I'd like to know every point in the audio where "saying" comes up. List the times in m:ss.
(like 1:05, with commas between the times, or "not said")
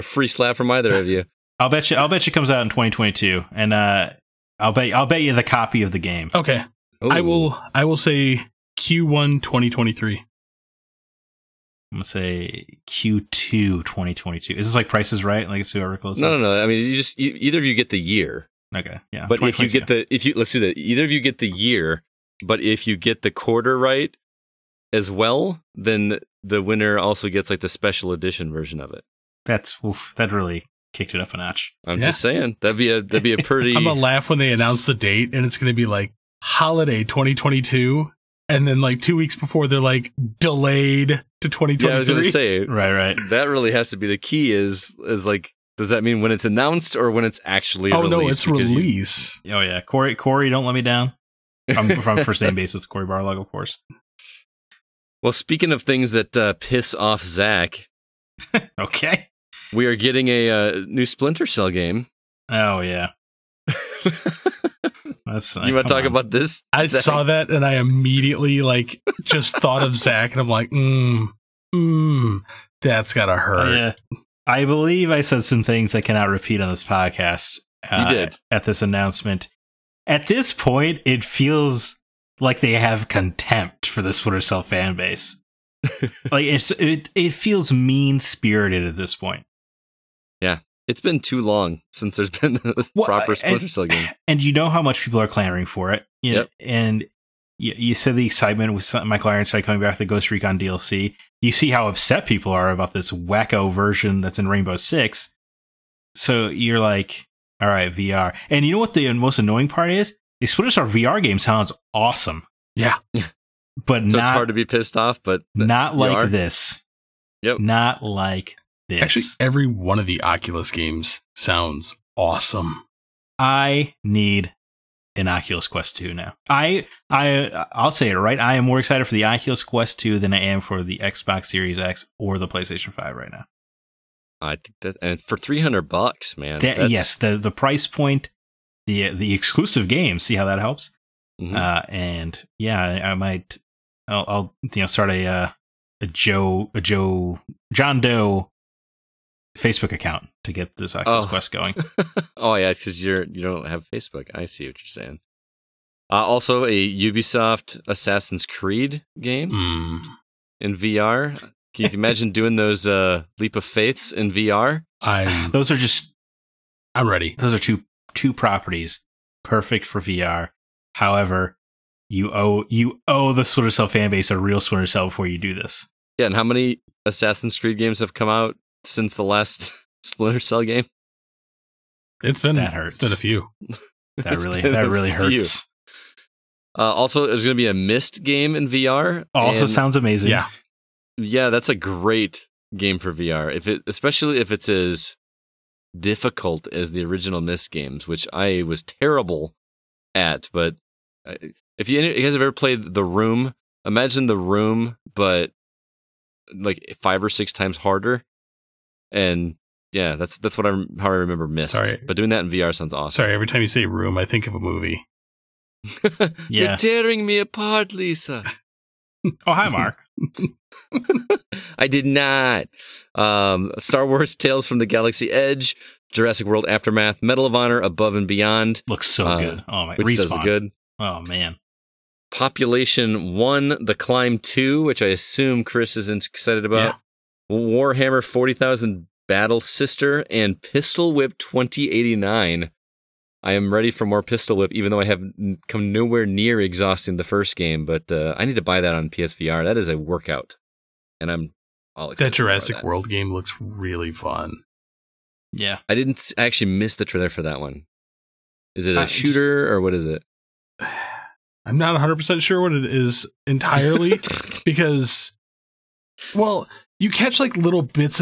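0:32, 2:35.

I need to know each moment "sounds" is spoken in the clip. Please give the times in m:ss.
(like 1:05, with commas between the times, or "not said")
1:51, 2:01, 3:09, 3:32.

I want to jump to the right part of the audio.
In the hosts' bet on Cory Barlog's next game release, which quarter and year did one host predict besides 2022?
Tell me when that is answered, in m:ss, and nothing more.
0:08.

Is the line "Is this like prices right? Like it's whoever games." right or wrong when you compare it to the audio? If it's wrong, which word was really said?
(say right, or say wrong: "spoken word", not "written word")
wrong: "closes", not "games".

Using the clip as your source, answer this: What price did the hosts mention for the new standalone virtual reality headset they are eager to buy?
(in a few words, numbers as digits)
$300.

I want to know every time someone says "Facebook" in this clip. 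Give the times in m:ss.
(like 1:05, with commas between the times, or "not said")
2:29, 2:33.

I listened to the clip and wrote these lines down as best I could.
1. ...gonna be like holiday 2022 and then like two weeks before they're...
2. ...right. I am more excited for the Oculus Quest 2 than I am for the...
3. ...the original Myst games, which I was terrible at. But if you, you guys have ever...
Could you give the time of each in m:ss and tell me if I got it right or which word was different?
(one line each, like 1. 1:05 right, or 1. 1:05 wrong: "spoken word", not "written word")
1. 0:35 right
2. 2:08 right
3. 3:16 right.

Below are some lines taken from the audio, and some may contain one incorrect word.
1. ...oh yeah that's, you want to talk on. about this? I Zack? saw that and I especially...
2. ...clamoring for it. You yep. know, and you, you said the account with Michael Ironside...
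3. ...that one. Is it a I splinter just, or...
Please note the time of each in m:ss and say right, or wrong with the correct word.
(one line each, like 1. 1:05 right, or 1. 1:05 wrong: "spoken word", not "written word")
1. 1:02 wrong: "immediately", not "especially"
2. 1:35 wrong: "excitement", not "account"
3. 4:17 wrong: "shooter", not "splinter".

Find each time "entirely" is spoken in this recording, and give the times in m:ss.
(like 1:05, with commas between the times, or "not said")
4:23.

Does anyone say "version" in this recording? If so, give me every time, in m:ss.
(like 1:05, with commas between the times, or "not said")
0:28, 1:43.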